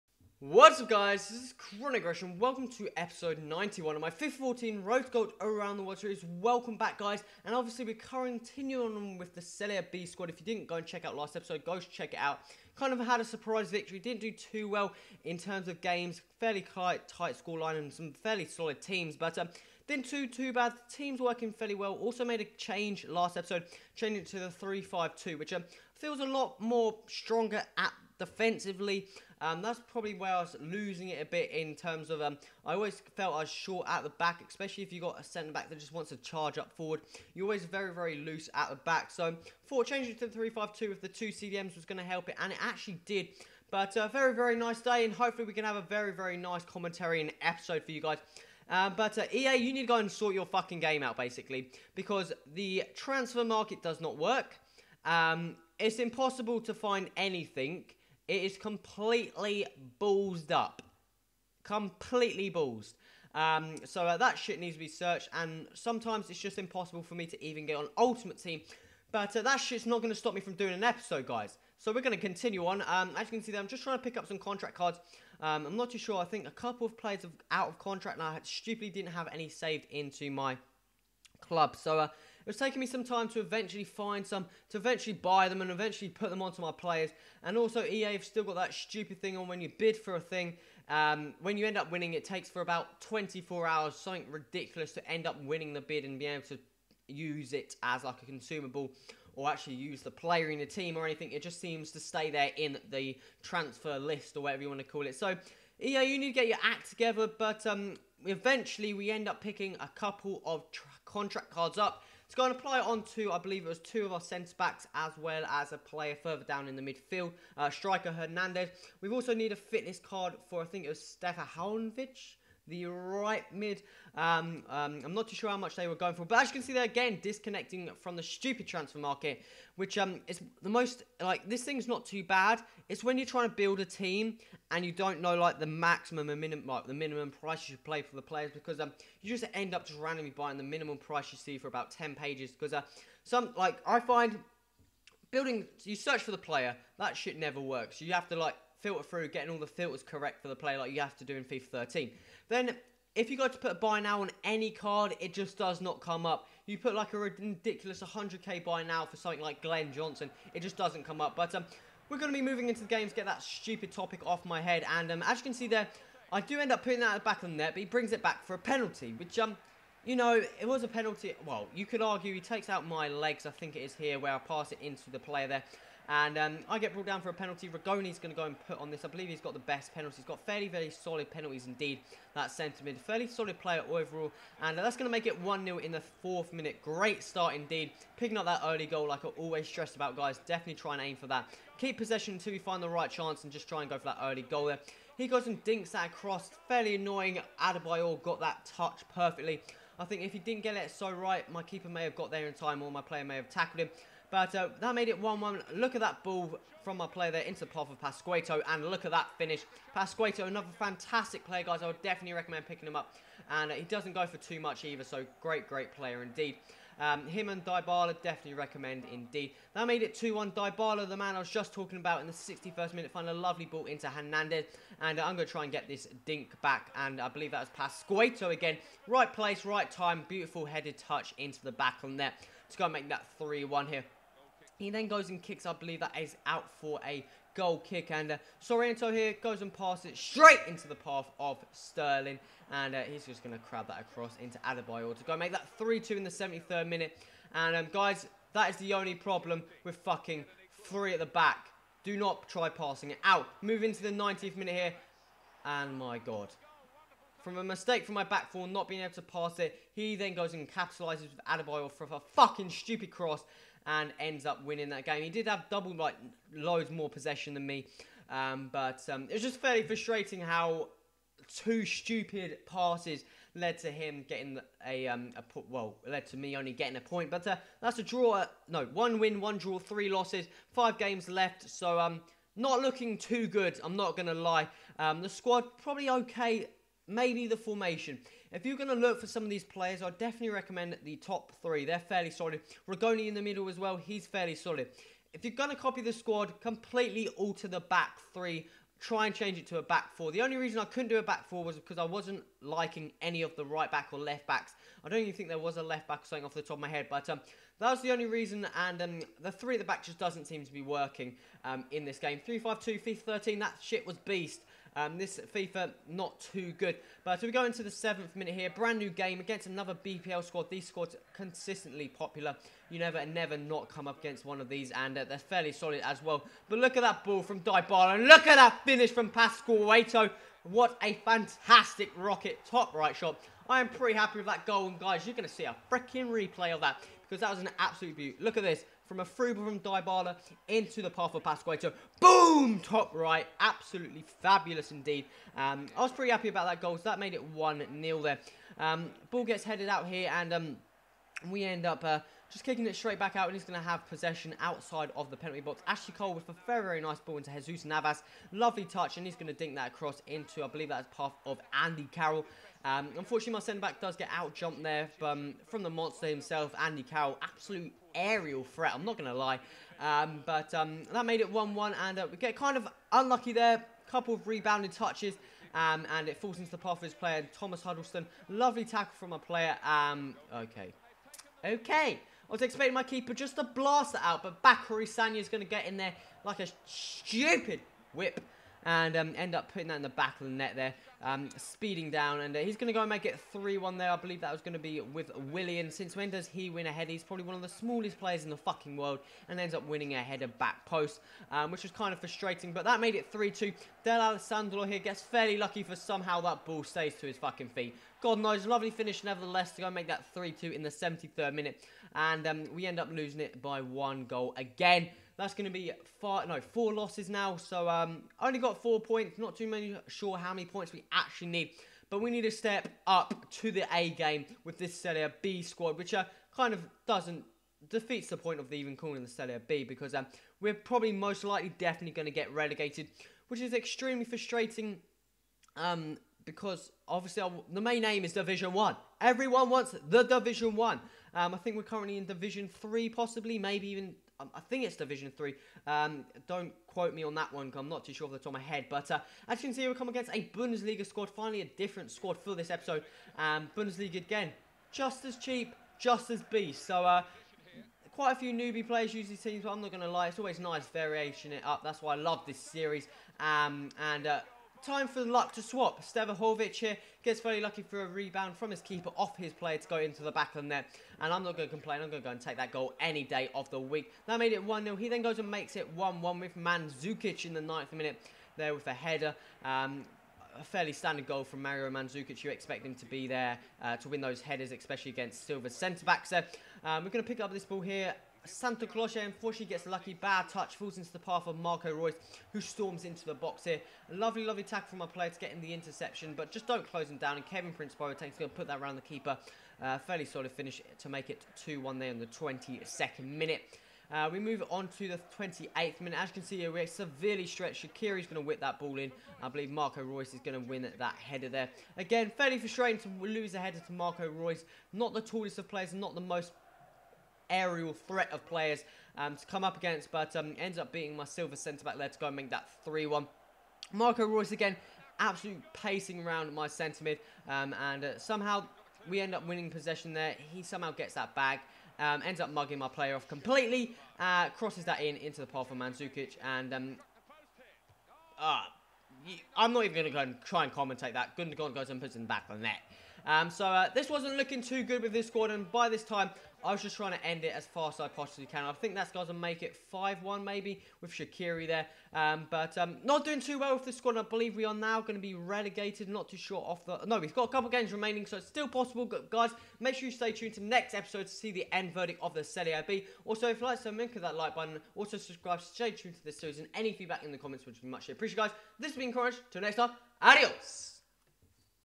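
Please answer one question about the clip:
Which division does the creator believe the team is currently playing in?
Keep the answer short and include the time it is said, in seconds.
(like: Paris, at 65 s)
Division 3, at 444 s.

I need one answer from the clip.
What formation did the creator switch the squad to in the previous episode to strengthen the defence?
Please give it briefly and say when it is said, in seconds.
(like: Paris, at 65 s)
3-5-2, at 24 s.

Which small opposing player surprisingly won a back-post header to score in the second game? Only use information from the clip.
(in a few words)
Willian.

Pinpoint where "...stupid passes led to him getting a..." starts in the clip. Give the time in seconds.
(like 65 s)
271 s.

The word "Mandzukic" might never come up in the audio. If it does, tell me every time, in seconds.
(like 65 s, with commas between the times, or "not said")
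476 s, 481 s, 535 s.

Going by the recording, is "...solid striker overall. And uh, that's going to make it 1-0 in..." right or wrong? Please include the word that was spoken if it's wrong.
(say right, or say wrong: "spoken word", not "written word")
wrong: "player", not "striker".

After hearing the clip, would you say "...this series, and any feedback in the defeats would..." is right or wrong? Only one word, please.
wrong.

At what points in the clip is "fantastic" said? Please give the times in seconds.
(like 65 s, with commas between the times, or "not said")
210 s, 331 s.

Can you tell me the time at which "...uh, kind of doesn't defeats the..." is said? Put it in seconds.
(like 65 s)
426 s.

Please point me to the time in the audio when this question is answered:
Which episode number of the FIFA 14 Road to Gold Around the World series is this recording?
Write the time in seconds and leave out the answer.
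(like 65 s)
2 s.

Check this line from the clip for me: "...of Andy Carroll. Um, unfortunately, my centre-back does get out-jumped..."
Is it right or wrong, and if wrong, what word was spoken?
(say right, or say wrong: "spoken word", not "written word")
right.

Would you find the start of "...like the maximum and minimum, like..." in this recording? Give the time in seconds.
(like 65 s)
135 s.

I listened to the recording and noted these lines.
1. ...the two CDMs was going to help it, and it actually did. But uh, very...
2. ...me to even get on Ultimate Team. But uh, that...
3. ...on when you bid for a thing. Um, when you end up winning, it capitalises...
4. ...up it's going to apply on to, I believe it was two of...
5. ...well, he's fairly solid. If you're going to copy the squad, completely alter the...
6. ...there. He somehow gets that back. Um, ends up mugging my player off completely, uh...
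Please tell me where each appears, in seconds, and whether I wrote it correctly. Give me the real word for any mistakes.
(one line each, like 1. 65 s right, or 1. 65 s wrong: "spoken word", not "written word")
1. 41 s right
2. 67 s right
3. 89 s wrong: "takes", not "capitalises"
4. 111 s right
5. 293 s right
6. 530 s right.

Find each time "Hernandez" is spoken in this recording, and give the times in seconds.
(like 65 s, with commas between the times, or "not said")
118 s, 224 s.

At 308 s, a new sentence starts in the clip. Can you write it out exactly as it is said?
And um, the three at the back just doesn't seem to be working um, in this game.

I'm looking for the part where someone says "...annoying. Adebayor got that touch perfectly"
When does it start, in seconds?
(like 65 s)
196 s.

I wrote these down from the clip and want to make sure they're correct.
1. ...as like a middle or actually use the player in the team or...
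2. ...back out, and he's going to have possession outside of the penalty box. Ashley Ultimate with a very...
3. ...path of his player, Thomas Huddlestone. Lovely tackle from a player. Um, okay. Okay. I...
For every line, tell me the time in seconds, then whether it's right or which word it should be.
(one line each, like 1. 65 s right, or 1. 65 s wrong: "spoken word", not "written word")
1. 97 s wrong: "consumable", not "middle"
2. 353 s wrong: "Cole", not "Ultimate"
3. 376 s right.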